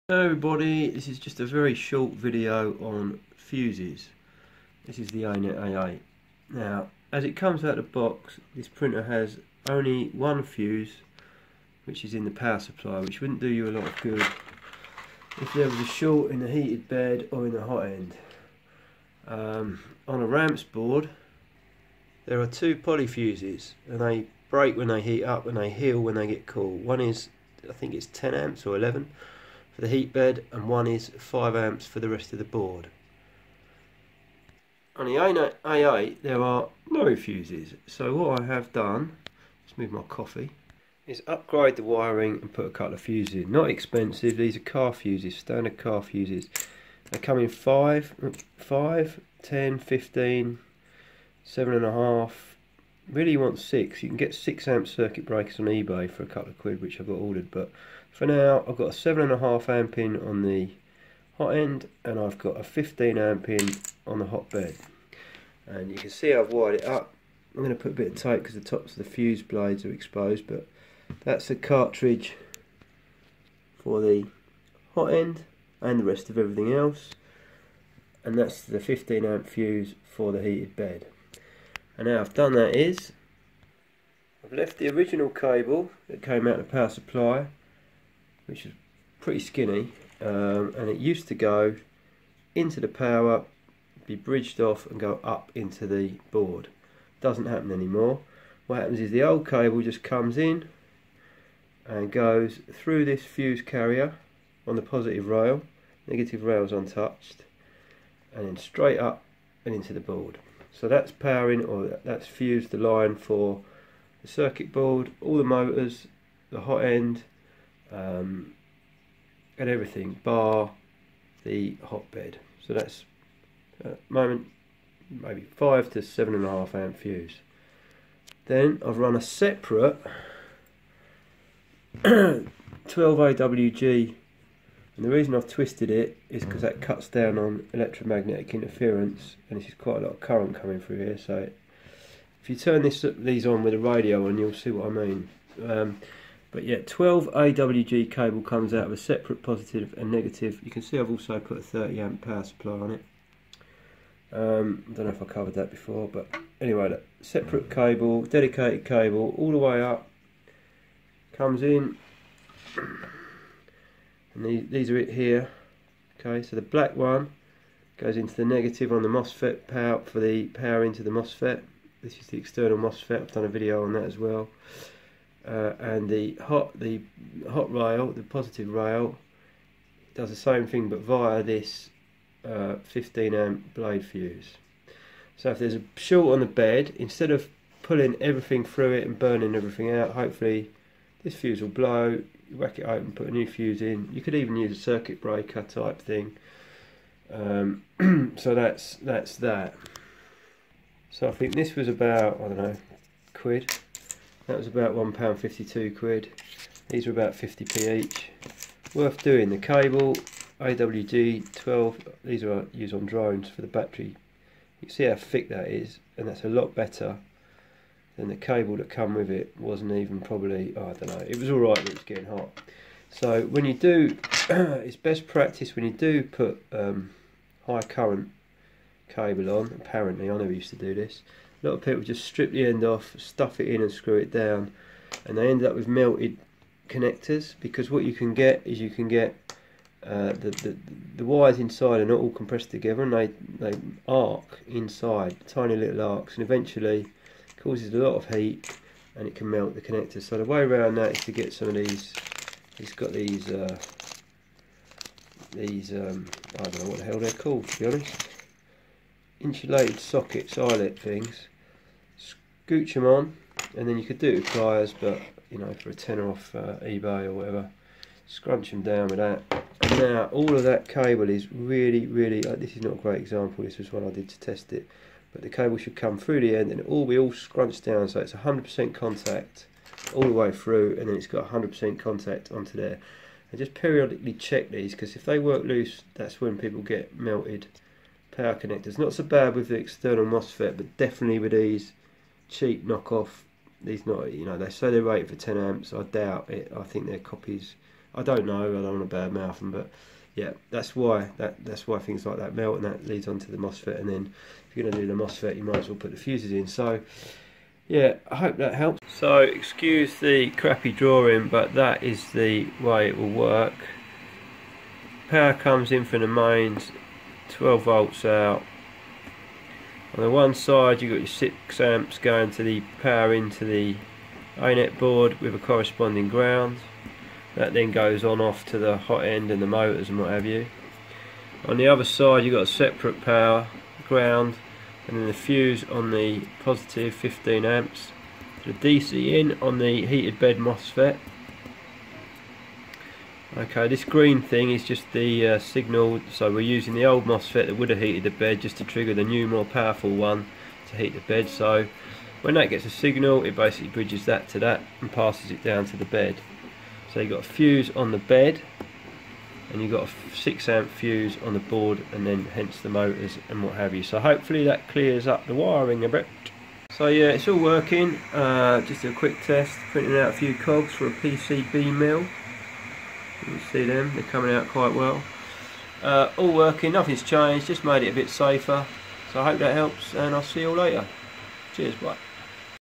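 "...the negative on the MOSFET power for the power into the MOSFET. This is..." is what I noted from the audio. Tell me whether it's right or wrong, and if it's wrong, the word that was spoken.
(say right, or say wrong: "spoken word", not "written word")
right.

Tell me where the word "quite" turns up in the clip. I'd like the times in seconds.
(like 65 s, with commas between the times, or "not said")
139 s, 374 s.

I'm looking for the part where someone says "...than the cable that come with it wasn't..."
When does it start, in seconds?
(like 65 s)
218 s.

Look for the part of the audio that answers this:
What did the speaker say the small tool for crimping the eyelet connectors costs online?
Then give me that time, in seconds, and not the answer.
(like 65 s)
265 s.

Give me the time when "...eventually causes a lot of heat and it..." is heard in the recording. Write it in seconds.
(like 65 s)
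246 s.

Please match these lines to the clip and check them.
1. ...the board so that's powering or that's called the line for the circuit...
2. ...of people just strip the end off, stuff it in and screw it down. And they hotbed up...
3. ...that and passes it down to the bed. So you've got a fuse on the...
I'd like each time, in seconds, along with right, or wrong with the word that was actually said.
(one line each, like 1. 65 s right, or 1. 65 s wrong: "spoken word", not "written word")
1. 109 s wrong: "fused", not "called"
2. 231 s wrong: "ended", not "hotbed"
3. 354 s right.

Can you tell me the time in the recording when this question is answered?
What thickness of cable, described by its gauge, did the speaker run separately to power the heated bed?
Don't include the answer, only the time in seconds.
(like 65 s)
132 s.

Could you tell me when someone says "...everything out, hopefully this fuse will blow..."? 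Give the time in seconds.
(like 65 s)
189 s.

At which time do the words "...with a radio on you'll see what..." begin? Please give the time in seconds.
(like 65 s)
143 s.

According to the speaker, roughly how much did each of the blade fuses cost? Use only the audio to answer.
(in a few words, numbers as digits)
50p.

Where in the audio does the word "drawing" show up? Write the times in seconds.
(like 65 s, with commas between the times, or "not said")
310 s.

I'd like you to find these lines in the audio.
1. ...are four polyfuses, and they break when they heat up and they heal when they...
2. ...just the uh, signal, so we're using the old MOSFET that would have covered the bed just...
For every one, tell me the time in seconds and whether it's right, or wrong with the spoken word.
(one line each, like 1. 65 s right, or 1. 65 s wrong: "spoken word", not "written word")
1. 22 s wrong: "two", not "four"
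2. 344 s wrong: "heated", not "covered".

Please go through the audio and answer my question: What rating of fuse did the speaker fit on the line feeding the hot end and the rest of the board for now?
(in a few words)
7.5 amp.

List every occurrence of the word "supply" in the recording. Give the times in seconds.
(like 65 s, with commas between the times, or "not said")
12 s, 86 s, 152 s.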